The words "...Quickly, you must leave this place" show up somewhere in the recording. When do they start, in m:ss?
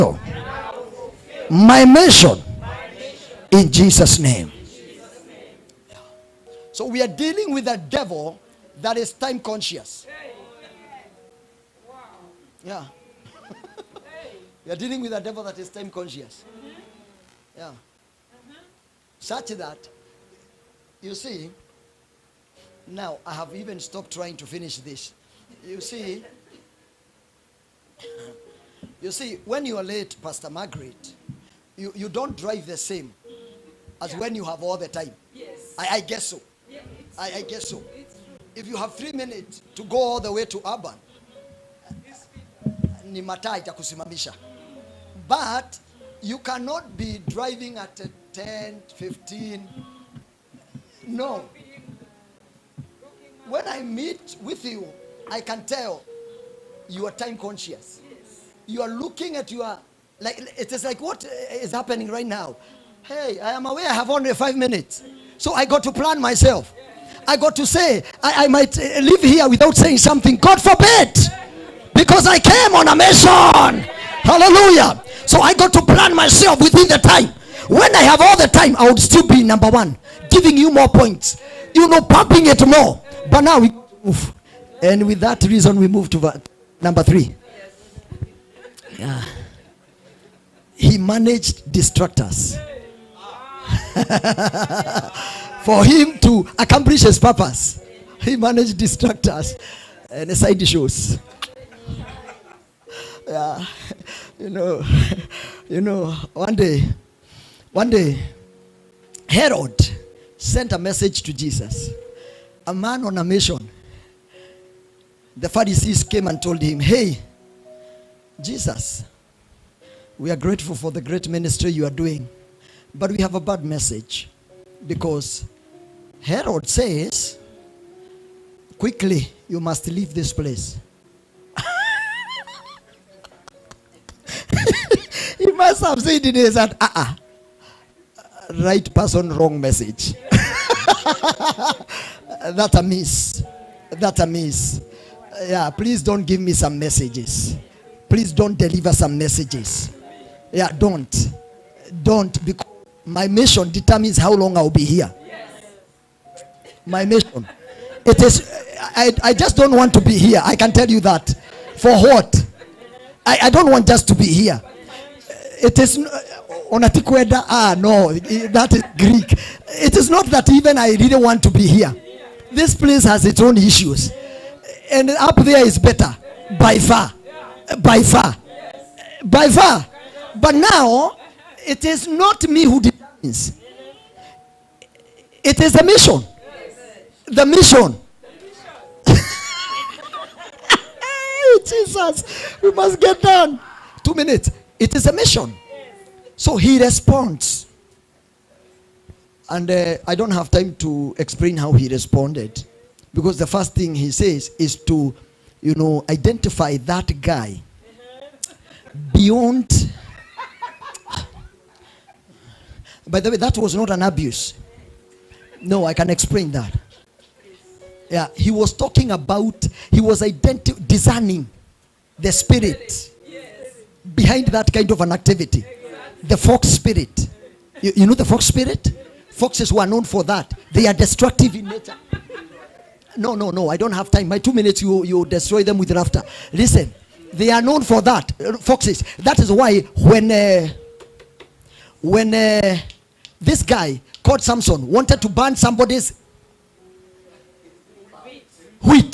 2:08.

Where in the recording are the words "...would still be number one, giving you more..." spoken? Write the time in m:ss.
1:18.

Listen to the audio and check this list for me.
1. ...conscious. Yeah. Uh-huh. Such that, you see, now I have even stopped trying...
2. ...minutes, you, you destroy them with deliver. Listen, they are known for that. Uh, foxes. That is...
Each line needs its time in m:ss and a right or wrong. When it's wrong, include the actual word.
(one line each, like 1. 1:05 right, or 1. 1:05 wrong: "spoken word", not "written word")
1. 0:15 right
2. 3:54 wrong: "laughter", not "deliver".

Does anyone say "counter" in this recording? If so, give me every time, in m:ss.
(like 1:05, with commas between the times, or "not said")
not said.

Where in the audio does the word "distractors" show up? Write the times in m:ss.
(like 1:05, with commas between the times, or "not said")
1:31, 1:38.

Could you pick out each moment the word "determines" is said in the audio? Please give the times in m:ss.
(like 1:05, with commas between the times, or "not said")
2:33, 3:02.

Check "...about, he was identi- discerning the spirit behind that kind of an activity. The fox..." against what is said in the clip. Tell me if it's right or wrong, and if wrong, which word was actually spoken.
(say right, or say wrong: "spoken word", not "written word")
right.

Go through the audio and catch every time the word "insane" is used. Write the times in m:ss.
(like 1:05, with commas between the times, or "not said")
not said.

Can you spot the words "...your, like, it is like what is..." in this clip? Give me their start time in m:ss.
0:59.